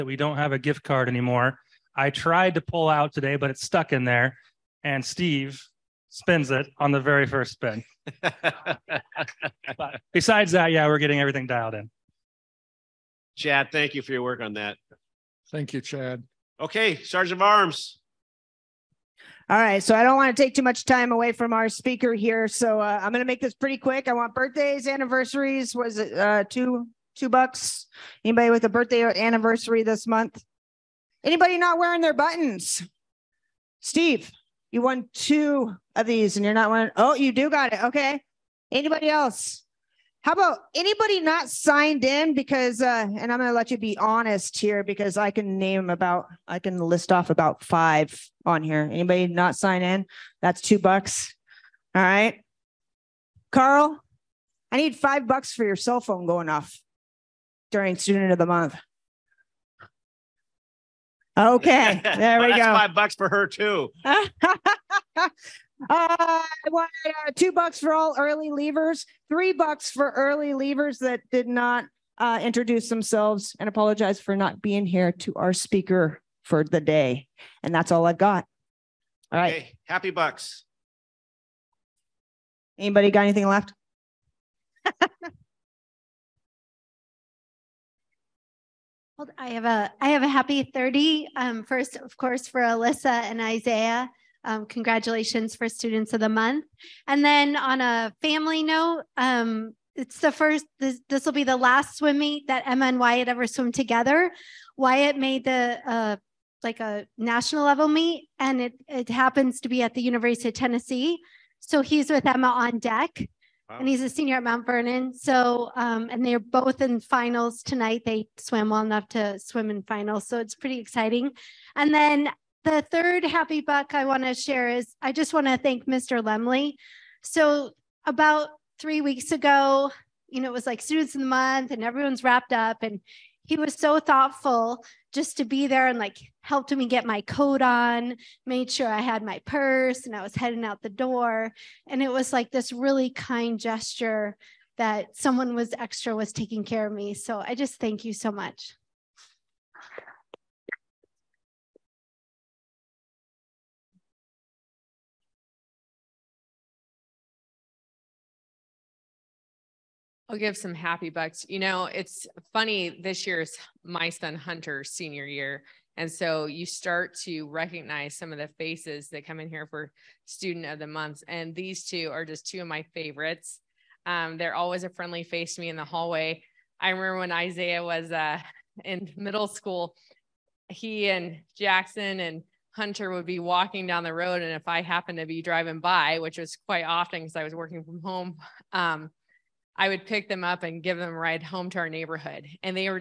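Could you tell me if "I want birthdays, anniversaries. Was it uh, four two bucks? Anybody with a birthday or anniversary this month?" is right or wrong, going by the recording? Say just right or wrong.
wrong.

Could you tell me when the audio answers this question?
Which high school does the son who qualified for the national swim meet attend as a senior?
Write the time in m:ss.
1:54.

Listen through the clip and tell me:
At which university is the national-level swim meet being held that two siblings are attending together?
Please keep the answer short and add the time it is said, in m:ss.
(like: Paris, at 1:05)
University of Tennessee, at 1:50.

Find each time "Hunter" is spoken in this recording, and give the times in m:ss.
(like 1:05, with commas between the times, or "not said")
2:44, 3:02.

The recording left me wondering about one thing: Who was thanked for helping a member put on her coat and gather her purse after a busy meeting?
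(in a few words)
Mr. Lemley.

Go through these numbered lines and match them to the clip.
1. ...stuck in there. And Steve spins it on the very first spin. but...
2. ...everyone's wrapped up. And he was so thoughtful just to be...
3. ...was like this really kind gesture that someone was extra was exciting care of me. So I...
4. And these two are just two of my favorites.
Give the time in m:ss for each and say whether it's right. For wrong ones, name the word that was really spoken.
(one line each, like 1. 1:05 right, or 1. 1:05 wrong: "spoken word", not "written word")
1. 0:03 right
2. 2:11 right
3. 2:22 wrong: "taking", not "exciting"
4. 2:51 right.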